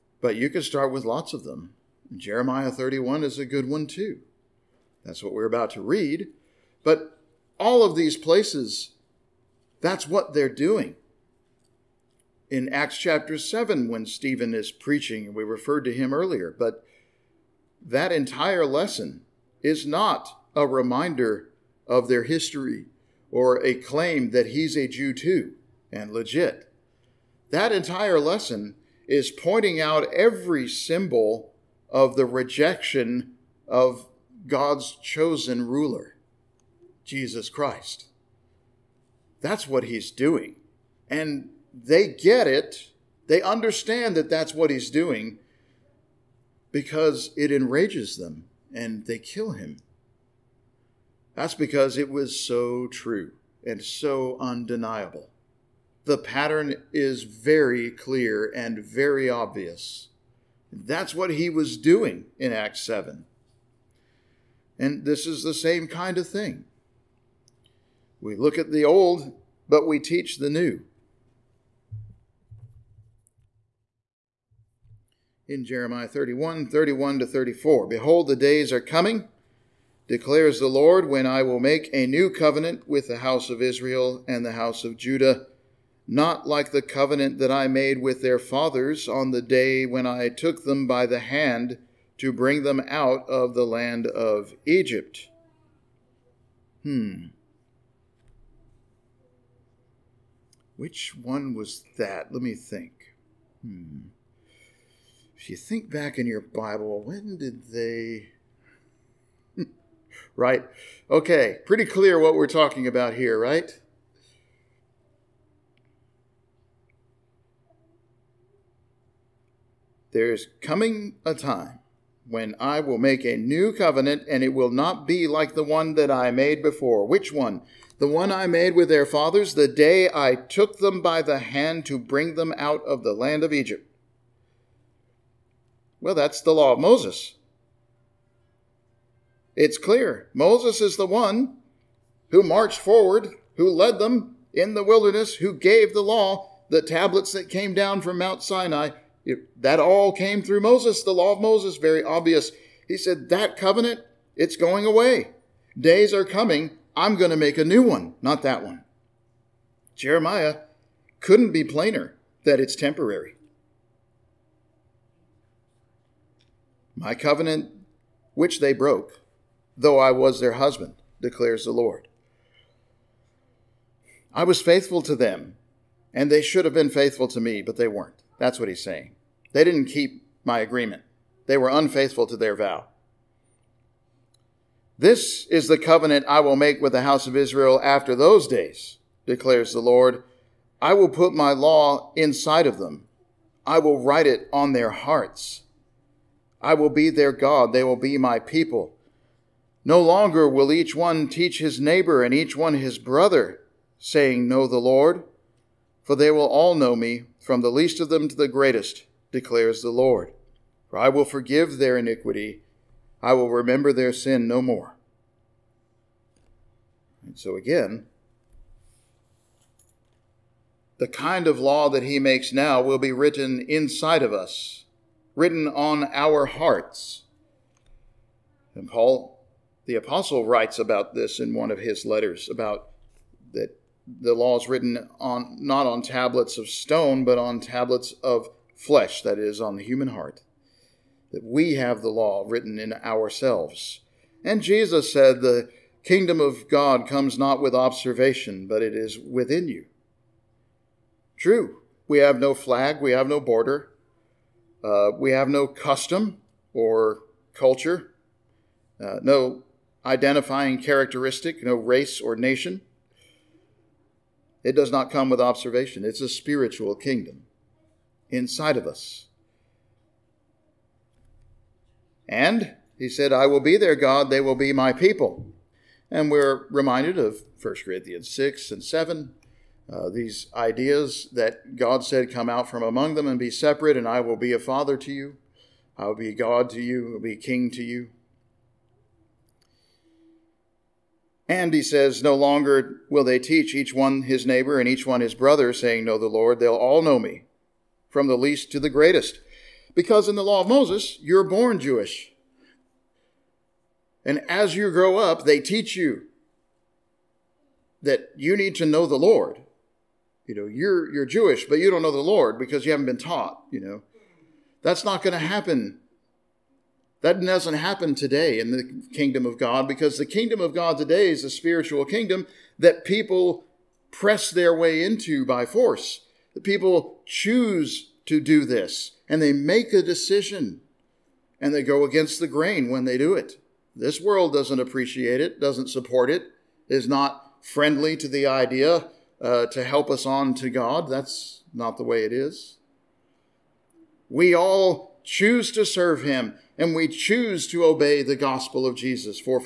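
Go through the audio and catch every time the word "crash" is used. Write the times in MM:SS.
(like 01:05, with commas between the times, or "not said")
not said.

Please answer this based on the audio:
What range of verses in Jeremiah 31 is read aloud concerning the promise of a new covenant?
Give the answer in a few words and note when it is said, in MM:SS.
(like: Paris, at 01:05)
31 to 34, at 01:16.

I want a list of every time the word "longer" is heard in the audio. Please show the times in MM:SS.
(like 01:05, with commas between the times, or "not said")
03:19, 04:52.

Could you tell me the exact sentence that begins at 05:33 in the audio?
This world doesn't appreciate it, doesn't support it, is not friendly to the idea uh, to help us on to God.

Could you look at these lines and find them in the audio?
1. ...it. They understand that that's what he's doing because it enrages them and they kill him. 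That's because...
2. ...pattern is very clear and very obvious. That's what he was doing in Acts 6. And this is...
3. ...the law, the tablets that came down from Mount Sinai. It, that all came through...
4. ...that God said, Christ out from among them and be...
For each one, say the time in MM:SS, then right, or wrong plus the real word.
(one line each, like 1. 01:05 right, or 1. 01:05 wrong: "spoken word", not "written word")
1. 00:42 right
2. 00:56 wrong: "7", not "6"
3. 02:25 right
4. 04:41 wrong: "Come", not "Christ".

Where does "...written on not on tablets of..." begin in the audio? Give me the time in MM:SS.
03:54.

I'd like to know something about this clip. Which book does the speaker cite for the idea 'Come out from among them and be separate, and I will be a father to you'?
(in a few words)
1 Corinthians.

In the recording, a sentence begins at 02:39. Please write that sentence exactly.
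Jeremiah couldn't be plainer that it's temporary.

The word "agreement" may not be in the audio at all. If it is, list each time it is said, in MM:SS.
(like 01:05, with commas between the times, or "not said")
03:00.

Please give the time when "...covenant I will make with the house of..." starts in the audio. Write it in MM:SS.
03:05.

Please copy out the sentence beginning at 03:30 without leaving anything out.
For I will forgive their iniquity, I will remember their sin no more.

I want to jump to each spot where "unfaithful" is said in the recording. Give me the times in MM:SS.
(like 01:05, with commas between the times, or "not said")
03:01.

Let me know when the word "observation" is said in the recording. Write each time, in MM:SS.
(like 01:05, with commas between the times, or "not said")
04:07, 04:25.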